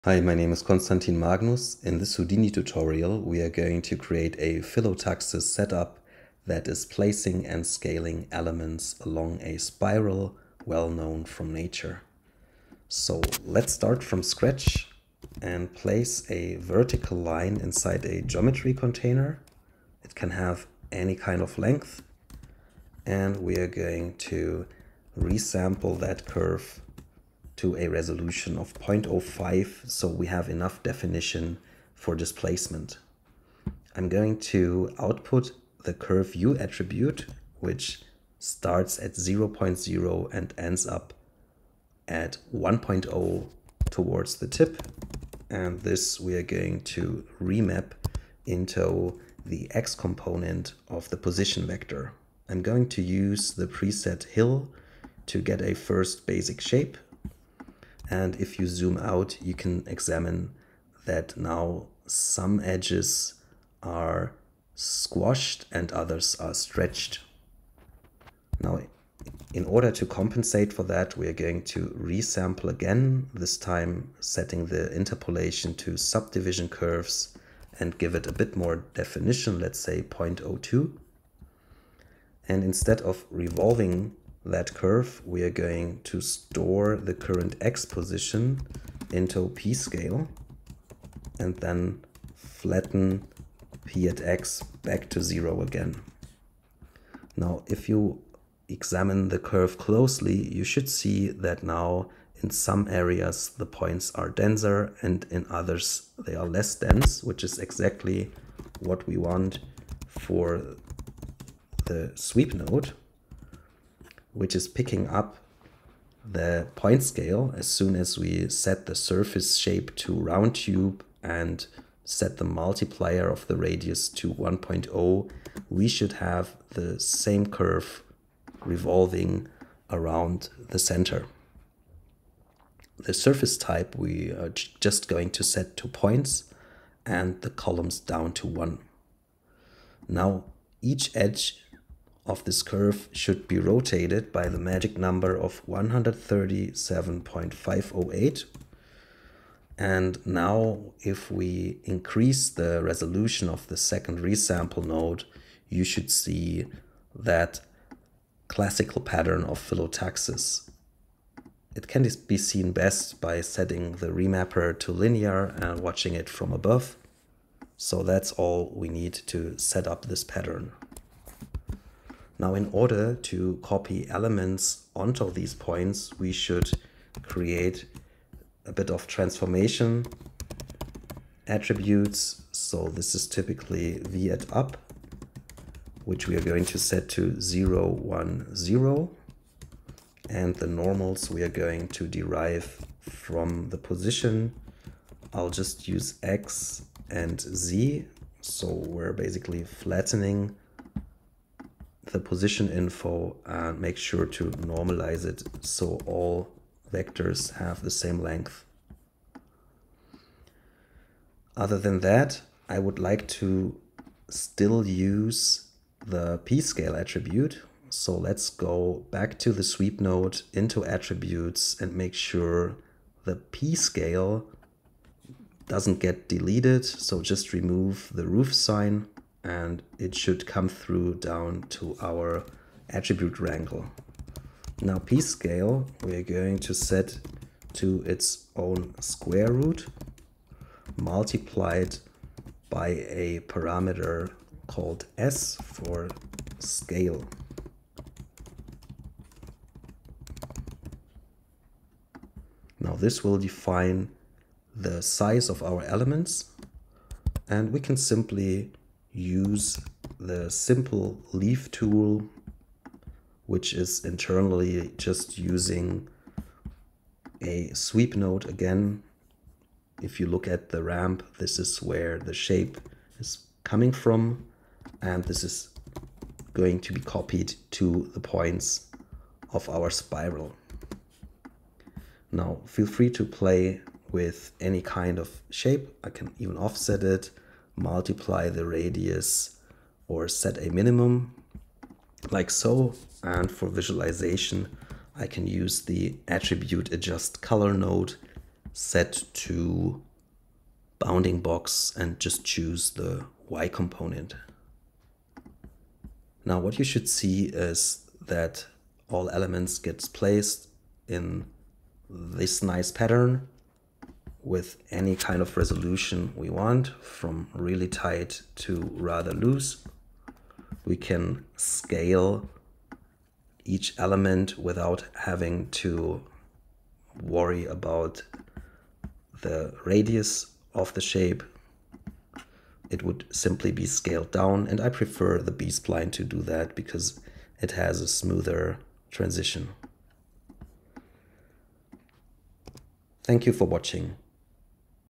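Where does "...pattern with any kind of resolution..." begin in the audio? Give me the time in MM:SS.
05:12.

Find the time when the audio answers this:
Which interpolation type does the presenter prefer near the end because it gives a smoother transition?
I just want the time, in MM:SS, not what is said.
05:35.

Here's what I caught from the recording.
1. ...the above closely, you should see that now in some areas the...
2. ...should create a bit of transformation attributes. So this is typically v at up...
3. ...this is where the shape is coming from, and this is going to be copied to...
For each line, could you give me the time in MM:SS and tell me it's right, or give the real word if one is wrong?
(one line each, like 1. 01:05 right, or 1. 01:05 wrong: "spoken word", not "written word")
1. 01:39 wrong: "curve", not "above"
2. 02:56 right
3. 04:31 right.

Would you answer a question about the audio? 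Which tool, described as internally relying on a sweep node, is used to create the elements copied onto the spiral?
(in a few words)
simple leaf tool.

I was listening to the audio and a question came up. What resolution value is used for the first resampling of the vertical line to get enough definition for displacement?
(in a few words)
0.05.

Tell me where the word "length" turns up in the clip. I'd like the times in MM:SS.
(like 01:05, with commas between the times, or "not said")
00:21, 03:28.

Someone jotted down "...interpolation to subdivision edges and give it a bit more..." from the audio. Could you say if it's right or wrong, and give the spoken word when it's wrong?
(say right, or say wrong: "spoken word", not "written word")
wrong: "curves", not "edges".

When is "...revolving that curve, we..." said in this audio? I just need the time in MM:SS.
01:23.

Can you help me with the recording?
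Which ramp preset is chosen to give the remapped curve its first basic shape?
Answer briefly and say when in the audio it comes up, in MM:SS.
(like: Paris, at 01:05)
hill, at 00:54.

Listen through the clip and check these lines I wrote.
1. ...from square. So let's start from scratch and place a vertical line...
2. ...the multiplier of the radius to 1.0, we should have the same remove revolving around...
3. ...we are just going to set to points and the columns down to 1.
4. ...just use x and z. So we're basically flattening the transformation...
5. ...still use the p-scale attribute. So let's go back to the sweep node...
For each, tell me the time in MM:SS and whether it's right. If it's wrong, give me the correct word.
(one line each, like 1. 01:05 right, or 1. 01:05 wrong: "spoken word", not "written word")
1. 00:11 wrong: "nature", not "square"
2. 02:02 wrong: "curve", not "remove"
3. 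02:13 right
4. 03:15 wrong: "position", not "transformation"
5. 03:34 right.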